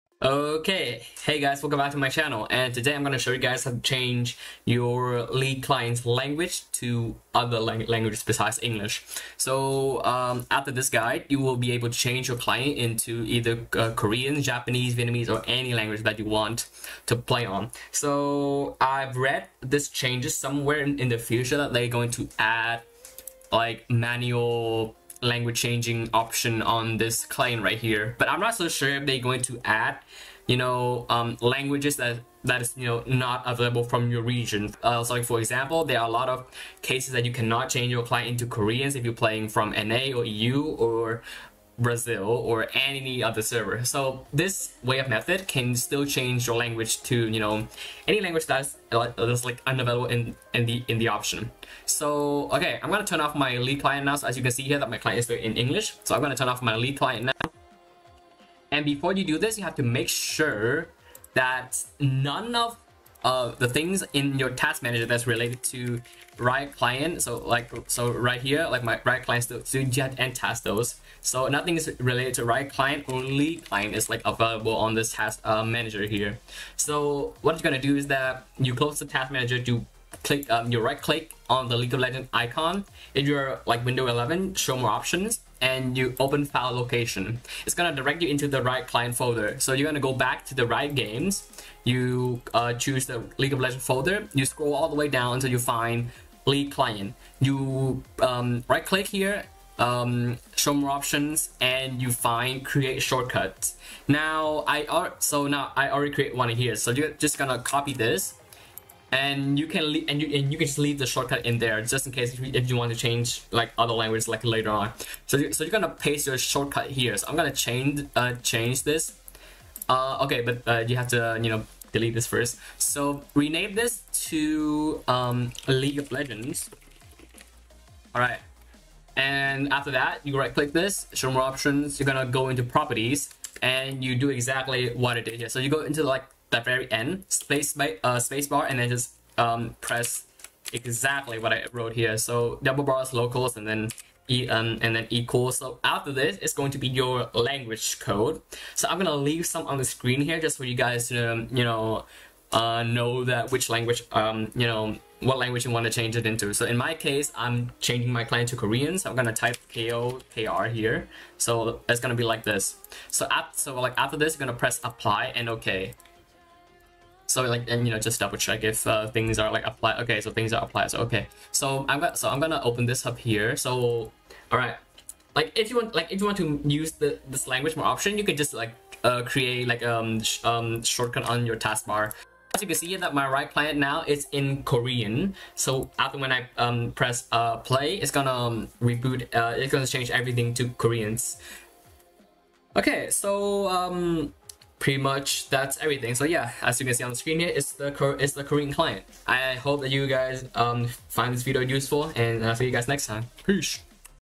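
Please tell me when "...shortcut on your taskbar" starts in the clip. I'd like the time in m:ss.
3:00.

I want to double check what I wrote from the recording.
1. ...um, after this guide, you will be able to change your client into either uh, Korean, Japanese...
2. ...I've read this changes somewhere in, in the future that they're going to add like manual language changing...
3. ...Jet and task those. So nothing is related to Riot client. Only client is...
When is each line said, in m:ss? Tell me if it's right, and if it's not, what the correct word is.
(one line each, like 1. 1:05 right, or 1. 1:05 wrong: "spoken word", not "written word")
1. 0:10 right
2. 0:18 right
3. 1:09 right.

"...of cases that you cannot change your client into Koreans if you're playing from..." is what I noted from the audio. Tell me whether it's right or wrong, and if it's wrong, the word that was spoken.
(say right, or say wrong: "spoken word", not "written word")
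right.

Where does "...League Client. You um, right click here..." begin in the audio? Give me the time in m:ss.
1:36.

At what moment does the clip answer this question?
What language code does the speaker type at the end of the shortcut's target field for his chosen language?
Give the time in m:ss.
2:39.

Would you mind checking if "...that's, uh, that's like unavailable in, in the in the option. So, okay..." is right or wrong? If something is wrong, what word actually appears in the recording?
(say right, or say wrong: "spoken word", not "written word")
right.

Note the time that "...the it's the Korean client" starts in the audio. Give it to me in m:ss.
3:17.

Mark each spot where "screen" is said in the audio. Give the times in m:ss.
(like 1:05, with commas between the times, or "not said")
2:29, 3:17.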